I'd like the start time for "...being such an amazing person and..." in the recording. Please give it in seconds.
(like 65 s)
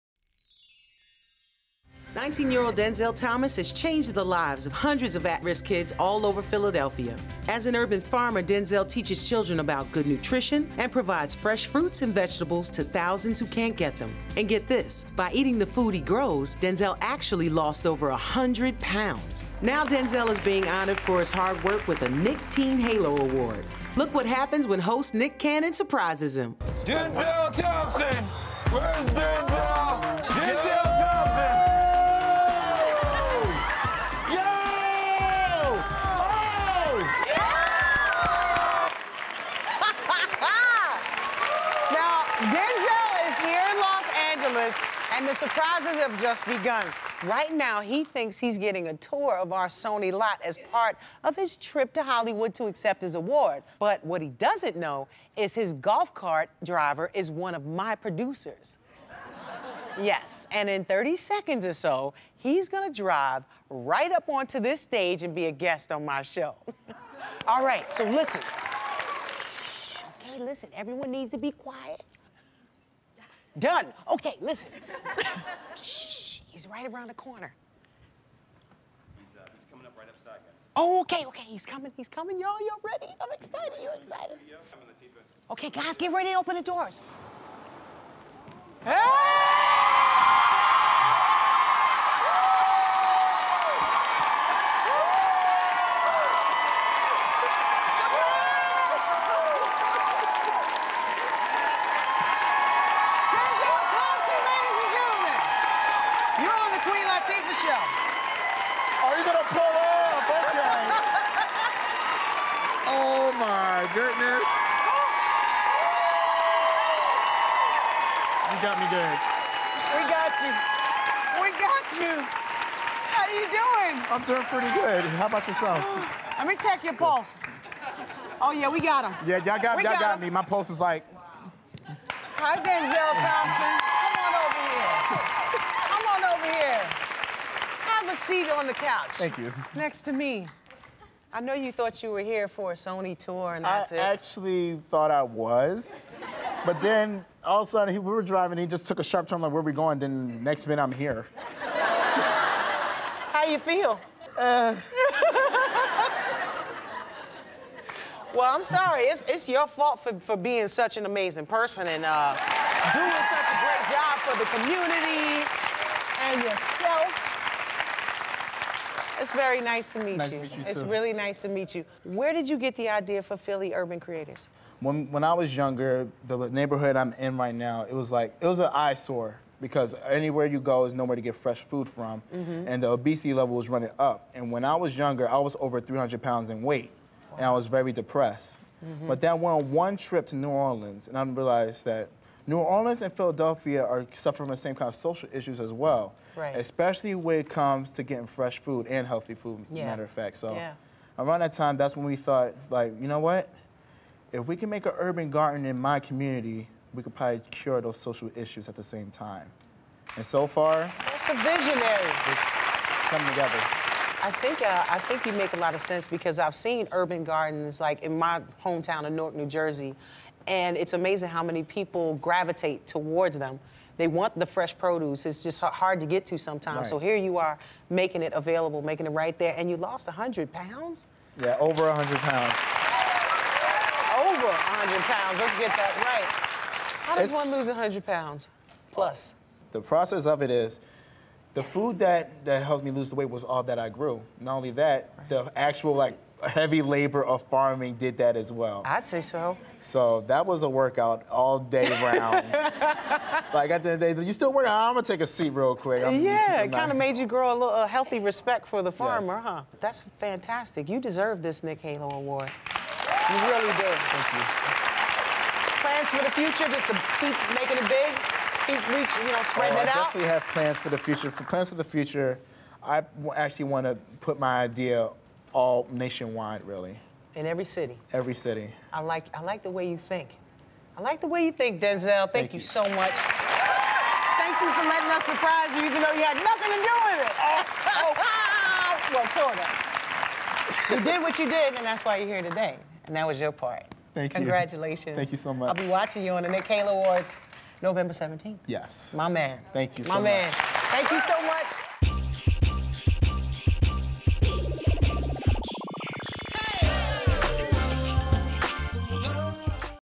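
160 s.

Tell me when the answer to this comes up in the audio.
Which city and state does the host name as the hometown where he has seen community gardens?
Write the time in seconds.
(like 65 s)
219 s.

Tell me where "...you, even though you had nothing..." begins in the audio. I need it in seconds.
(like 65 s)
285 s.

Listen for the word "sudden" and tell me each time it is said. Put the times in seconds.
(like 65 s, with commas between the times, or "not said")
147 s.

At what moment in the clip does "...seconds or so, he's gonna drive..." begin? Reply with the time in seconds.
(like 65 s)
61 s.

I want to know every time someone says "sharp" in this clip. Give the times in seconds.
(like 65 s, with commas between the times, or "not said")
149 s.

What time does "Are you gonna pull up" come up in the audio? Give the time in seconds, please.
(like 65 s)
107 s.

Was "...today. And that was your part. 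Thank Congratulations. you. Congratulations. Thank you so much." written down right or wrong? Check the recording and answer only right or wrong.
right.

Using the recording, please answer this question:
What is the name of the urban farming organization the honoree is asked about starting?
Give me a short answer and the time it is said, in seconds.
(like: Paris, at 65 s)
Philly Urban Creators, at 173 s.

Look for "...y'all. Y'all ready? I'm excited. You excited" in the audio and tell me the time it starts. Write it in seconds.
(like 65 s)
82 s.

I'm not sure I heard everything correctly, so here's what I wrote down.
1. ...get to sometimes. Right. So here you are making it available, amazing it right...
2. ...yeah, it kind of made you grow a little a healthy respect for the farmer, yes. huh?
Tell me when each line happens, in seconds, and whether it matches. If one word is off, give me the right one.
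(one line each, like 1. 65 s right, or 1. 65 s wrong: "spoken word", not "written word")
1. 226 s wrong: "making", not "amazing"
2. 256 s right.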